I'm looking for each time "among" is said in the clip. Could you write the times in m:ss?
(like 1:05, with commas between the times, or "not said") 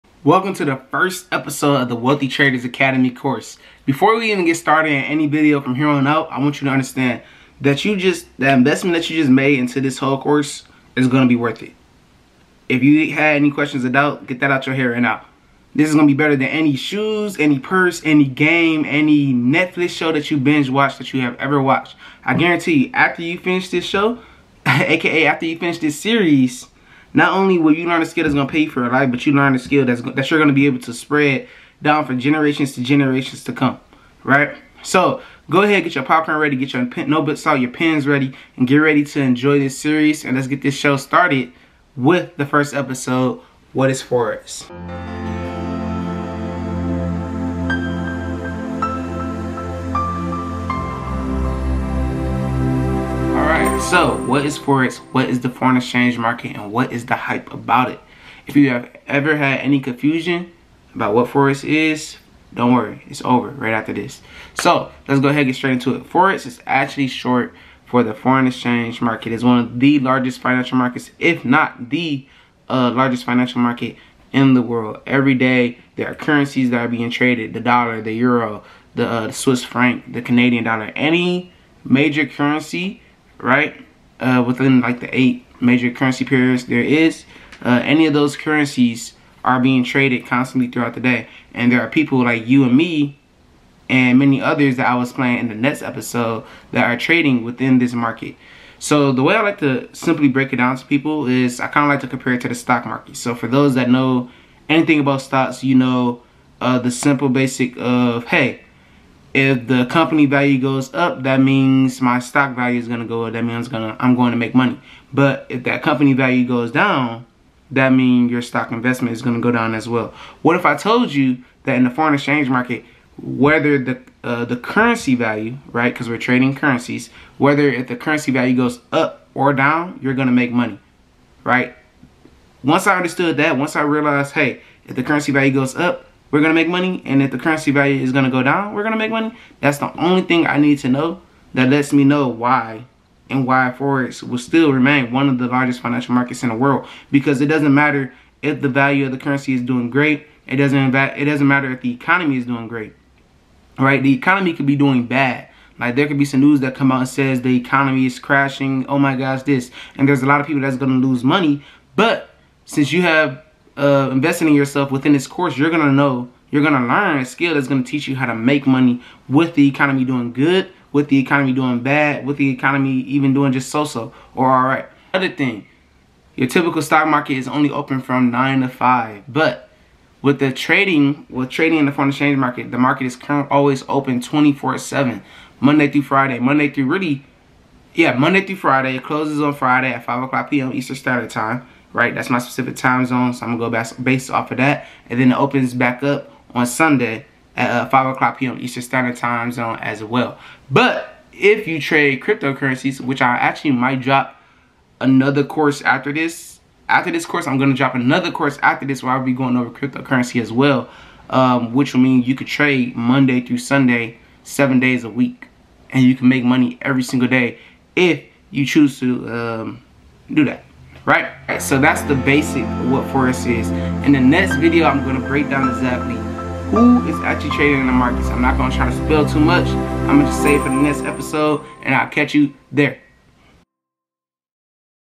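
not said.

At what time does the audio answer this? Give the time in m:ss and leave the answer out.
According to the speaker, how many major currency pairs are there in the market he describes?
1:25.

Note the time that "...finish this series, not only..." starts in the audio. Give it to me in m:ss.
0:25.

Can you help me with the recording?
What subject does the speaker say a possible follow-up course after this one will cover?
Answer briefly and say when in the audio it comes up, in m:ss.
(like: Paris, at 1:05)
Cryptocurrency, at 3:29.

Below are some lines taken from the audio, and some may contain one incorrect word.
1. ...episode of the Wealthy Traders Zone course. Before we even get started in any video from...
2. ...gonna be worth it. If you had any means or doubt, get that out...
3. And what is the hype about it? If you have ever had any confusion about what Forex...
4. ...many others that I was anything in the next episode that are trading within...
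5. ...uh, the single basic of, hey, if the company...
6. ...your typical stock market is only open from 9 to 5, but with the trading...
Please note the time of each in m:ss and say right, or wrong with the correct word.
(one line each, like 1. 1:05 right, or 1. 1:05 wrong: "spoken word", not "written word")
1. 0:01 wrong: "Academy", not "Zone"
2. 0:11 wrong: "questions", not "means"
3. 0:56 right
4. 1:34 wrong: "playing", not "anything"
5. 1:46 wrong: "simple", not "single"
6. 2:56 right.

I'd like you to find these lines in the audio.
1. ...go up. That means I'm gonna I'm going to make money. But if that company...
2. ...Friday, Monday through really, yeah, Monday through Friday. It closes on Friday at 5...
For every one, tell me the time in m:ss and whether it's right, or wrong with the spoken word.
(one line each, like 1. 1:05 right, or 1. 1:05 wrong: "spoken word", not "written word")
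1. 1:53 right
2. 3:06 right.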